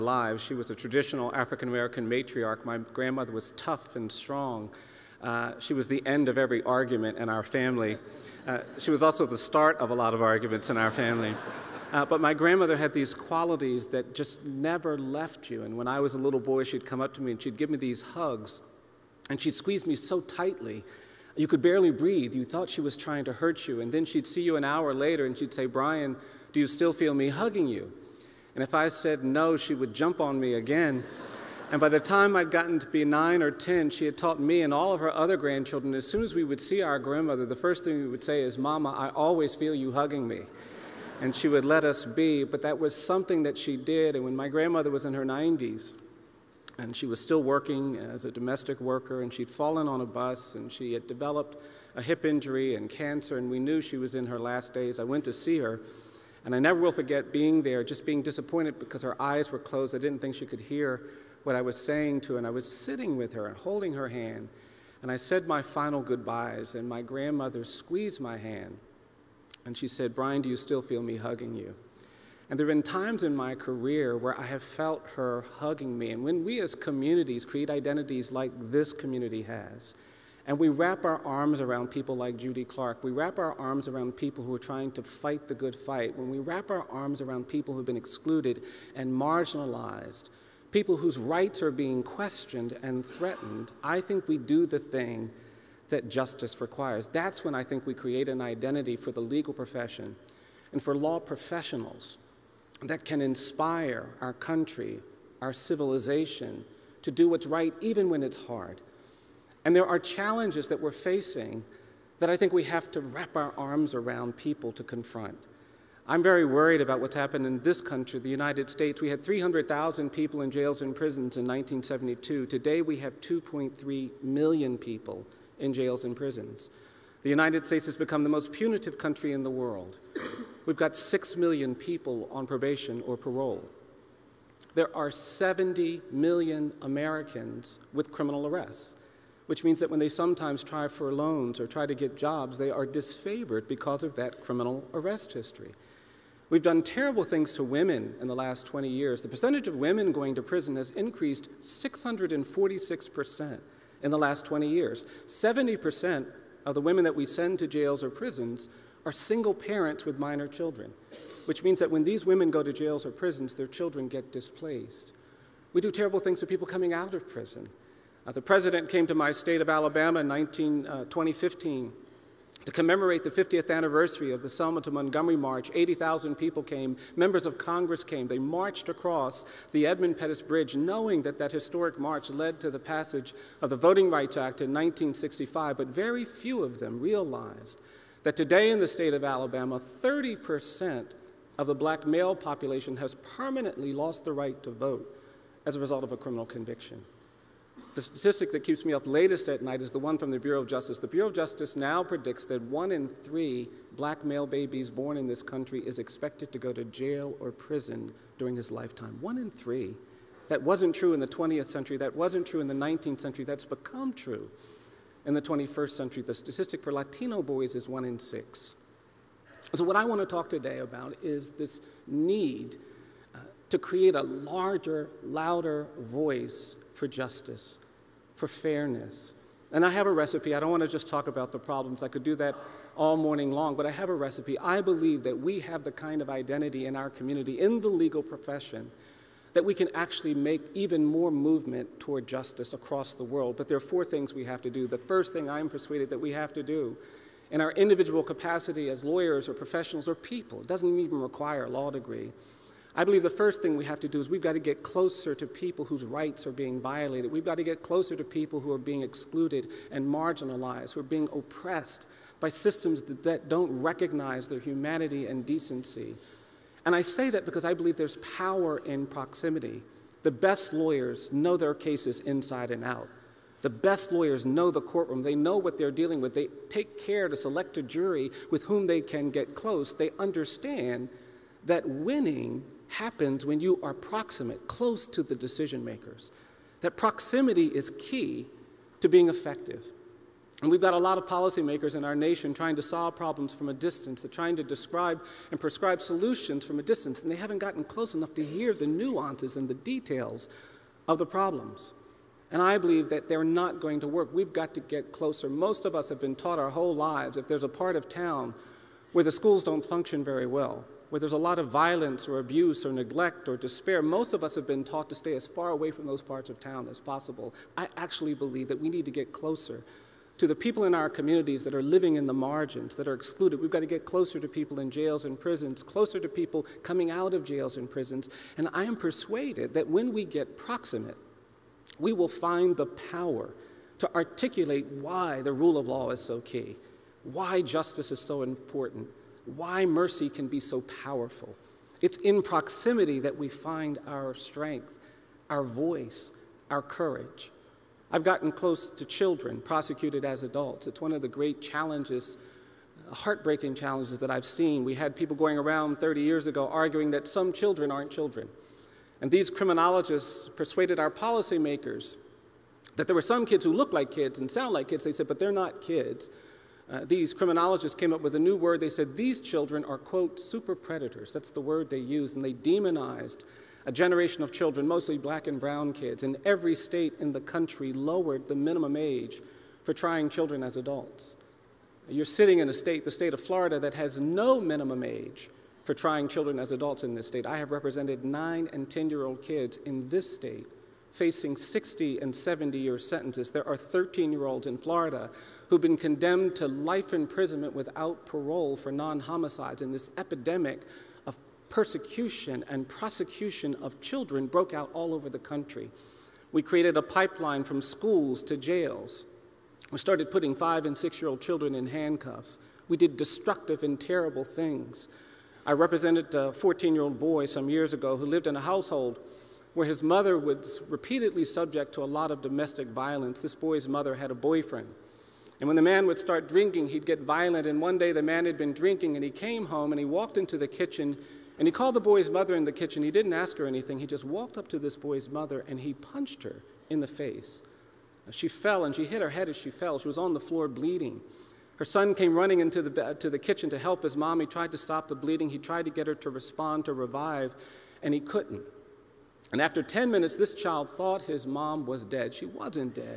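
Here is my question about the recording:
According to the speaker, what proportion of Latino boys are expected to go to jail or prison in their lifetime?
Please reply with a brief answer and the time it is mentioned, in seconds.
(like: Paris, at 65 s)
1 in 6, at 217 s.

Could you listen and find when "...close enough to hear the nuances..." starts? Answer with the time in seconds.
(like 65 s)
297 s.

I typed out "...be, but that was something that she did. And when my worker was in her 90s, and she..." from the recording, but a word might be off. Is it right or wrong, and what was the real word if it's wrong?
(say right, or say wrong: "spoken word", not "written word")
wrong: "grandmother", not "worker".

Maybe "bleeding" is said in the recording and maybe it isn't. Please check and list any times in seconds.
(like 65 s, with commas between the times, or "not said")
440 s, 445 s.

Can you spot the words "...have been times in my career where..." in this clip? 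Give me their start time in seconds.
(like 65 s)
72 s.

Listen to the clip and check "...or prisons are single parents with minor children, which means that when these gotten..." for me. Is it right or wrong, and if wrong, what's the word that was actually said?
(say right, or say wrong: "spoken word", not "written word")
wrong: "women", not "gotten".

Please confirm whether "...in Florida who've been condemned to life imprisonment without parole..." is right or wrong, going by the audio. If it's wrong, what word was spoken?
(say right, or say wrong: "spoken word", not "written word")
right.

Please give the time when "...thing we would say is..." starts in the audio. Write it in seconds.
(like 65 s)
37 s.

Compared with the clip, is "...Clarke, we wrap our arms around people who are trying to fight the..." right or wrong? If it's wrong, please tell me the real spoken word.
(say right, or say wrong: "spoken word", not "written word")
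right.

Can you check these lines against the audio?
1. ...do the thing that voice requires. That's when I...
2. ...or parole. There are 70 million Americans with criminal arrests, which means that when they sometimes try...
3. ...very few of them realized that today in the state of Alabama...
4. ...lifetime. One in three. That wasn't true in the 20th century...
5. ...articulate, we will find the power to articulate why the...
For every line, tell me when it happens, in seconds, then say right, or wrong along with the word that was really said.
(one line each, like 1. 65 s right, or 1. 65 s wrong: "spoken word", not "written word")
1. 94 s wrong: "justice", not "voice"
2. 133 s right
3. 185 s right
4. 208 s right
5. 330 s wrong: "proximate", not "articulate".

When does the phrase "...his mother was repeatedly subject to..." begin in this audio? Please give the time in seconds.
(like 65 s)
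419 s.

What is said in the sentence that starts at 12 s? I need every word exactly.
but my grandmother had these qualities that just never left you.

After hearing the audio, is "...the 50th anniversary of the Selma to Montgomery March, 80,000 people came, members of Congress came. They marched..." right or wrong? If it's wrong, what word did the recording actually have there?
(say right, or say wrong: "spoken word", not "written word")
right.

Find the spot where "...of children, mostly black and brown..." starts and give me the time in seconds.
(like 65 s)
374 s.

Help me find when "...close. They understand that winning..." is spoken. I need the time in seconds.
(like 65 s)
279 s.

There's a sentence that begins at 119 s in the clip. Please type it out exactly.
We had 300,000 people in jails and prisons in 1972.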